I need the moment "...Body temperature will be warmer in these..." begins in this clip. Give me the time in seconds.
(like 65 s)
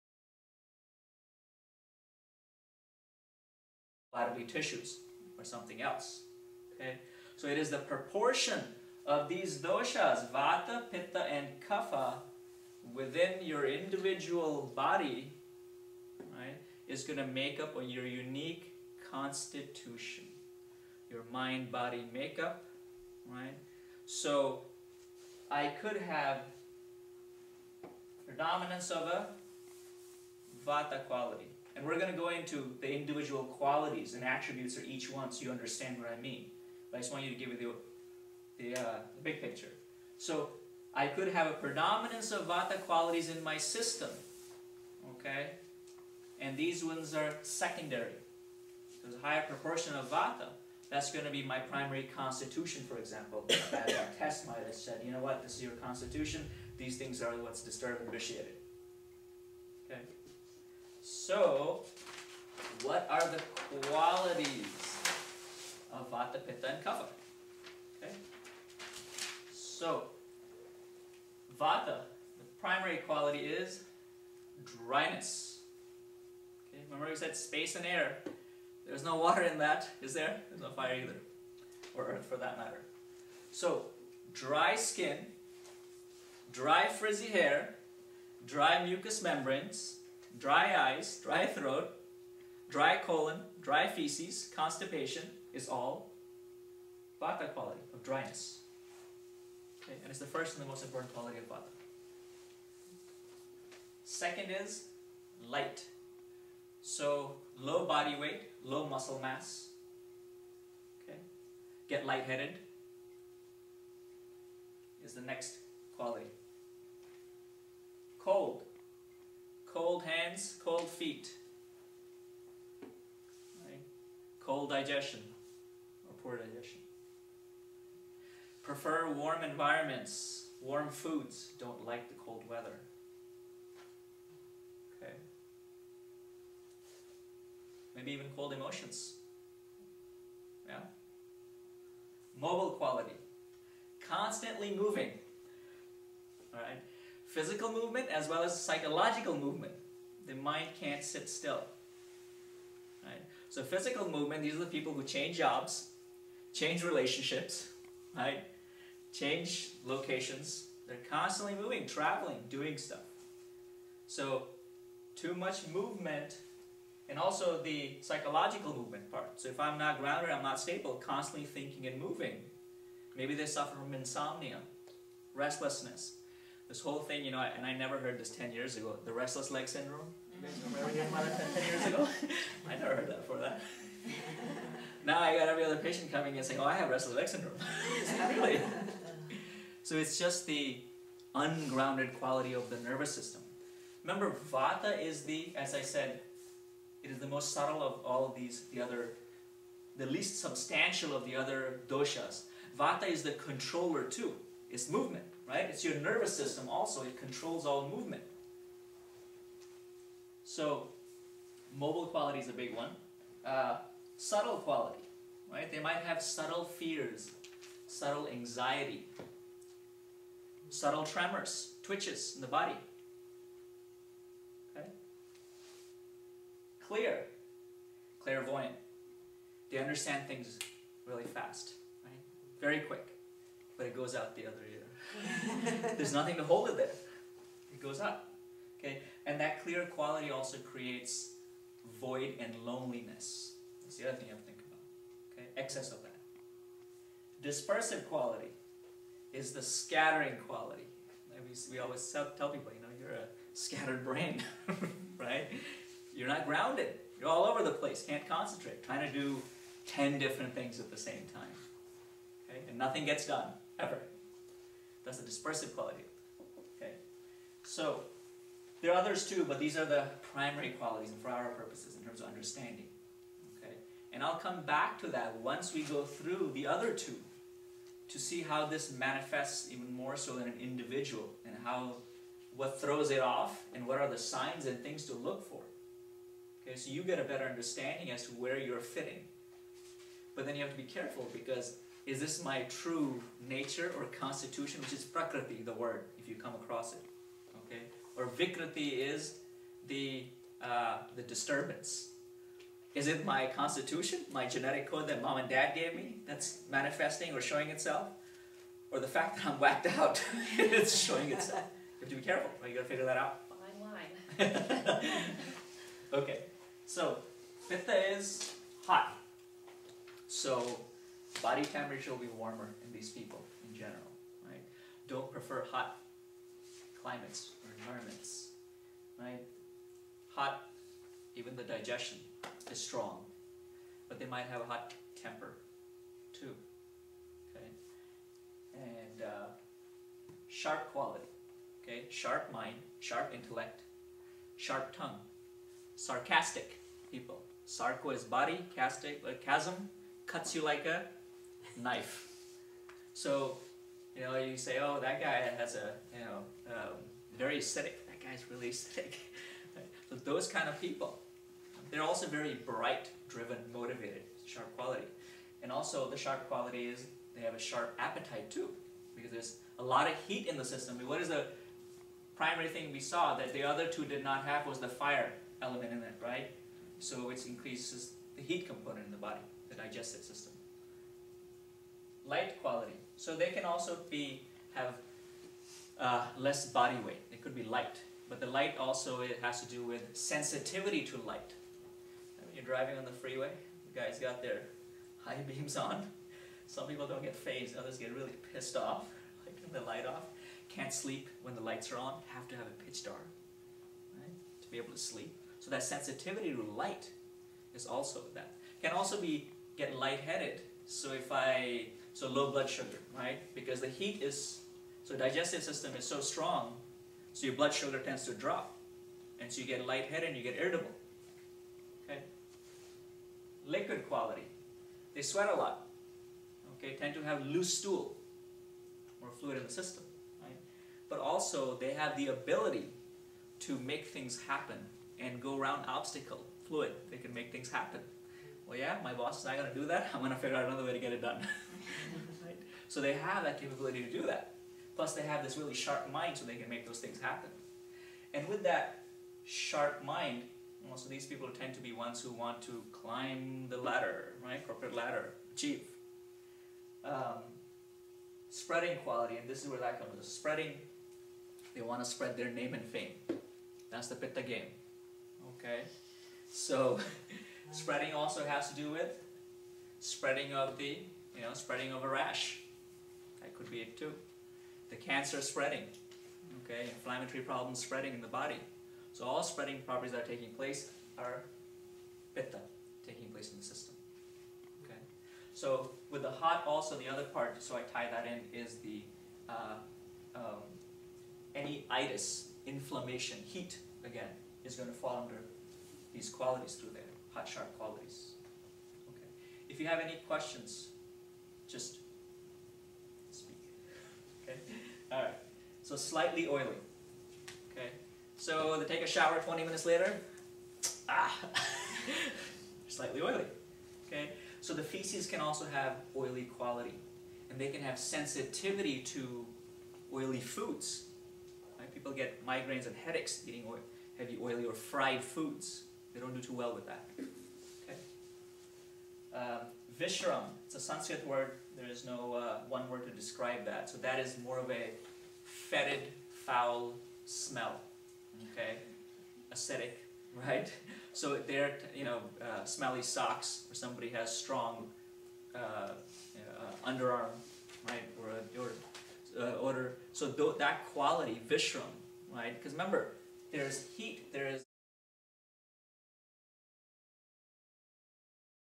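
321 s.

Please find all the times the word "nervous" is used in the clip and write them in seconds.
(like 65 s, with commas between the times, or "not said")
192 s, 205 s.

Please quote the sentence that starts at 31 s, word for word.
And we're going to go into the individual qualities and attributes of each one so you understand what I mean.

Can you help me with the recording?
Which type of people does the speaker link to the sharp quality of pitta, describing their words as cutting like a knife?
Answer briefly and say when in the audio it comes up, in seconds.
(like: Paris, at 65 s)
Sarcastic people, at 345 s.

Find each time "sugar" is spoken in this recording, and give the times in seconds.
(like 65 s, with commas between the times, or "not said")
412 s, 417 s.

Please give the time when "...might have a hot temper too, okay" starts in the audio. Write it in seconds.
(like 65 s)
334 s.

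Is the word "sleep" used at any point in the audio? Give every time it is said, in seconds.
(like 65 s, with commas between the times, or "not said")
400 s, 404 s.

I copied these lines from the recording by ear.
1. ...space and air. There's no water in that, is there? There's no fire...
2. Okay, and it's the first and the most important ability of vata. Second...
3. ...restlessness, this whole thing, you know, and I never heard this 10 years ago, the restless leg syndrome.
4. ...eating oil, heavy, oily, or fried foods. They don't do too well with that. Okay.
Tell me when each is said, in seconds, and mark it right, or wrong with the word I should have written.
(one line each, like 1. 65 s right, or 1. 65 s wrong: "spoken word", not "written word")
1. 77 s right
2. 99 s wrong: "quality", not "ability"
3. 175 s right
4. 523 s right.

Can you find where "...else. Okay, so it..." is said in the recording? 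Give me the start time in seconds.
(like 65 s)
5 s.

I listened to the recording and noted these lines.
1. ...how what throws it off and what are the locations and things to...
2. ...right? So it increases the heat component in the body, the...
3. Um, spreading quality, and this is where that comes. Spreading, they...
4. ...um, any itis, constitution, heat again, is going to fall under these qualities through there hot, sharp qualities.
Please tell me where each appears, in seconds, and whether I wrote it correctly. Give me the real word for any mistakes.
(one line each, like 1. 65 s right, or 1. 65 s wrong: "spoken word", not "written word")
1. 281 s wrong: "signs", not "locations"
2. 376 s right
3. 457 s right
4. 490 s wrong: "inflammation", not "constitution".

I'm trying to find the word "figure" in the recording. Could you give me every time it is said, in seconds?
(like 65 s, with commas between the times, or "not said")
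312 s, 440 s.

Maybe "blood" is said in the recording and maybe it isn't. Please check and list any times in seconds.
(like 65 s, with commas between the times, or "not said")
412 s, 417 s.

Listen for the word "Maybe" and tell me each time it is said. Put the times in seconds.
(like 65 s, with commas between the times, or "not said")
137 s, 173 s.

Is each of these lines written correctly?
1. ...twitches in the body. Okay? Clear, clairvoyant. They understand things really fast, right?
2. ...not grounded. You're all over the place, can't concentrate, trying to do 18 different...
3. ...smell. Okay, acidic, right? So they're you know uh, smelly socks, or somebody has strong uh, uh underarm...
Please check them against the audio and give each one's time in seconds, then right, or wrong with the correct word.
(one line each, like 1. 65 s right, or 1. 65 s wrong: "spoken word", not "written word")
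1. 221 s right
2. 256 s wrong: "10", not "18"
3. 537 s right.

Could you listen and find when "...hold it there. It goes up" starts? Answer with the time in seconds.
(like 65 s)
236 s.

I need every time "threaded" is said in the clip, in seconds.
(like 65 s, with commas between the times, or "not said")
not said.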